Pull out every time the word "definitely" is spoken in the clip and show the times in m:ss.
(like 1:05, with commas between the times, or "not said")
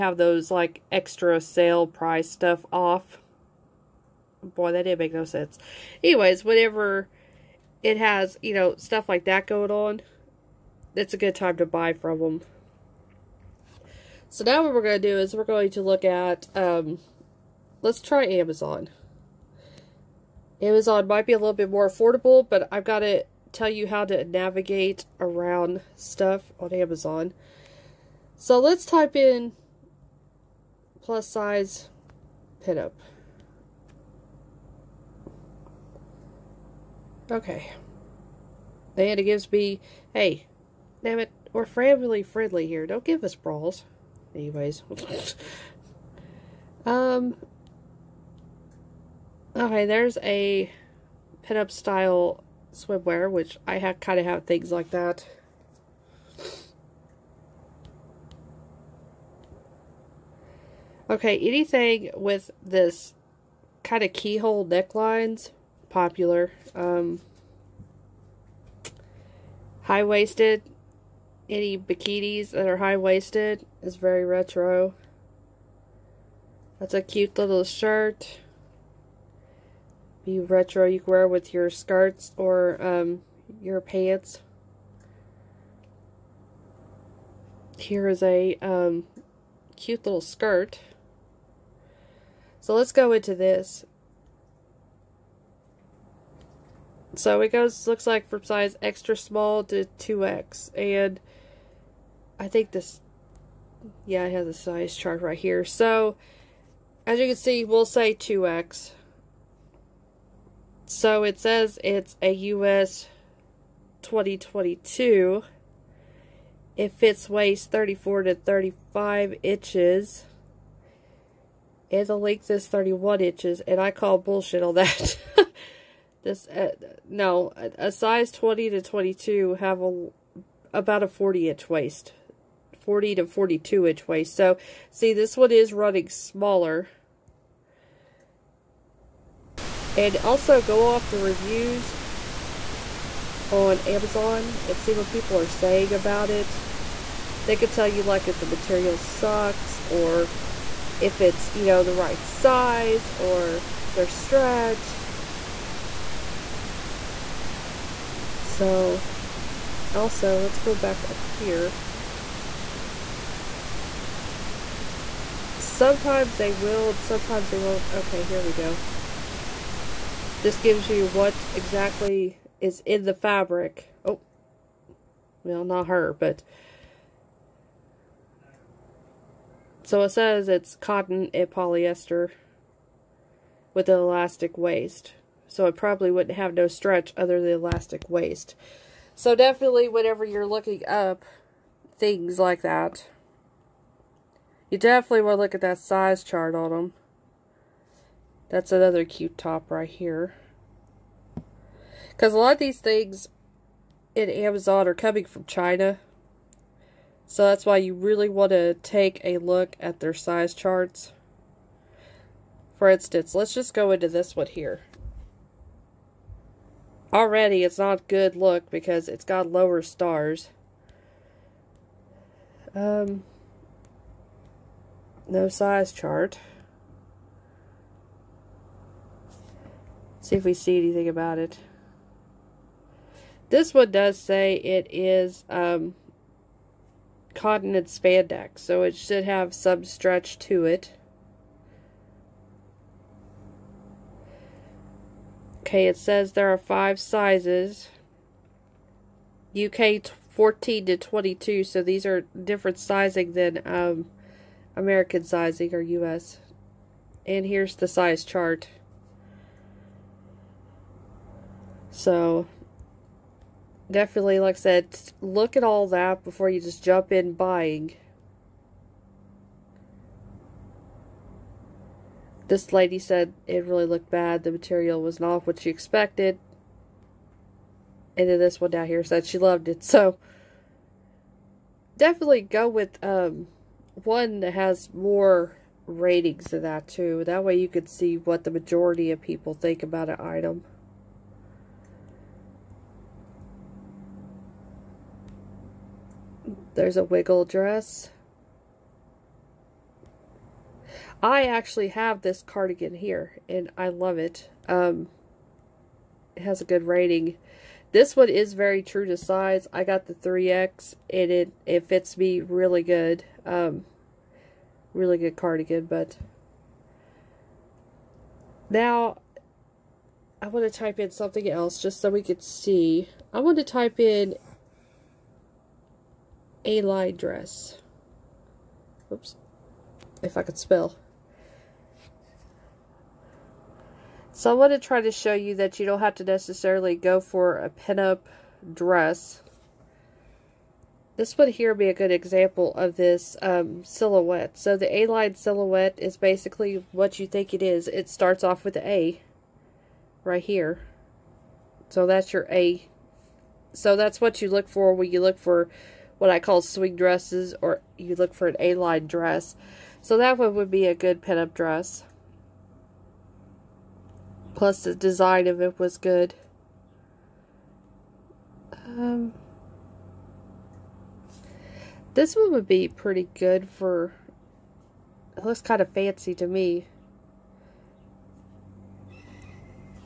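3:09, 3:14, 4:23, 4:41.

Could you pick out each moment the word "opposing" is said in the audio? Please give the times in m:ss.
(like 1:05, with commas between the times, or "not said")
not said.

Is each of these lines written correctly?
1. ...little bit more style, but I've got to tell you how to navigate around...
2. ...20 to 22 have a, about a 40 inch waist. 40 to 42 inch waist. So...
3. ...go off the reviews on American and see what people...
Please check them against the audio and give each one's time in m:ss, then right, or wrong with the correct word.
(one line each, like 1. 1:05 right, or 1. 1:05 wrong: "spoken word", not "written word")
1. 0:21 wrong: "affordable", not "style"
2. 2:08 right
3. 2:20 wrong: "Amazon", not "American".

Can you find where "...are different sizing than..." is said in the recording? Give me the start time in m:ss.
4:12.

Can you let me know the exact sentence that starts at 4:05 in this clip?
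Okay, it says there are five sizes.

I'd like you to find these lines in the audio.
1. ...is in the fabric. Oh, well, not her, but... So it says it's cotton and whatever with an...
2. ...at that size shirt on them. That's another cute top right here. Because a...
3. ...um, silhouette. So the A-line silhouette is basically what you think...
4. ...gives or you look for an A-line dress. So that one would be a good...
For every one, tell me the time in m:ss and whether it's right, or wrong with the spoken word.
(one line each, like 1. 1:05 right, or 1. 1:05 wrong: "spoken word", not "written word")
1. 2:52 wrong: "polyester", not "whatever"
2. 3:15 wrong: "chart", not "shirt"
3. 5:43 right
4. 5:56 wrong: "dresses", not "gives".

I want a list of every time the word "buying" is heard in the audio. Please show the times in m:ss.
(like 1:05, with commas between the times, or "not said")
4:27.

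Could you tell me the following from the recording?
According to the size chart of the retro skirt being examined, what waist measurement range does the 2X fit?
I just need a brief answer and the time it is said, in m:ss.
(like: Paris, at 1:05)
34 to 35 inches, at 1:57.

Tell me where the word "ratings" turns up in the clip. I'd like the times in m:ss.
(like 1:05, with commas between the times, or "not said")
4:45, 5:06.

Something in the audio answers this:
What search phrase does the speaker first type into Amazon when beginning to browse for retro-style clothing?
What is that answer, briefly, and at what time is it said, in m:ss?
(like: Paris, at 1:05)
plus size pinup, at 0:31.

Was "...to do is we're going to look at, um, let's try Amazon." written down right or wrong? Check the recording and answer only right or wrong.
right.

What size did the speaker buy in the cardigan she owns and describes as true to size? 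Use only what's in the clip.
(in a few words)
3X.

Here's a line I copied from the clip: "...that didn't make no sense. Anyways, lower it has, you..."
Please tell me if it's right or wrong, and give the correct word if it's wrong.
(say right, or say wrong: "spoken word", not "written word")
wrong: "whatever", not "lower".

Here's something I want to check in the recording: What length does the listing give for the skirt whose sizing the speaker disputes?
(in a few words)
31 inches.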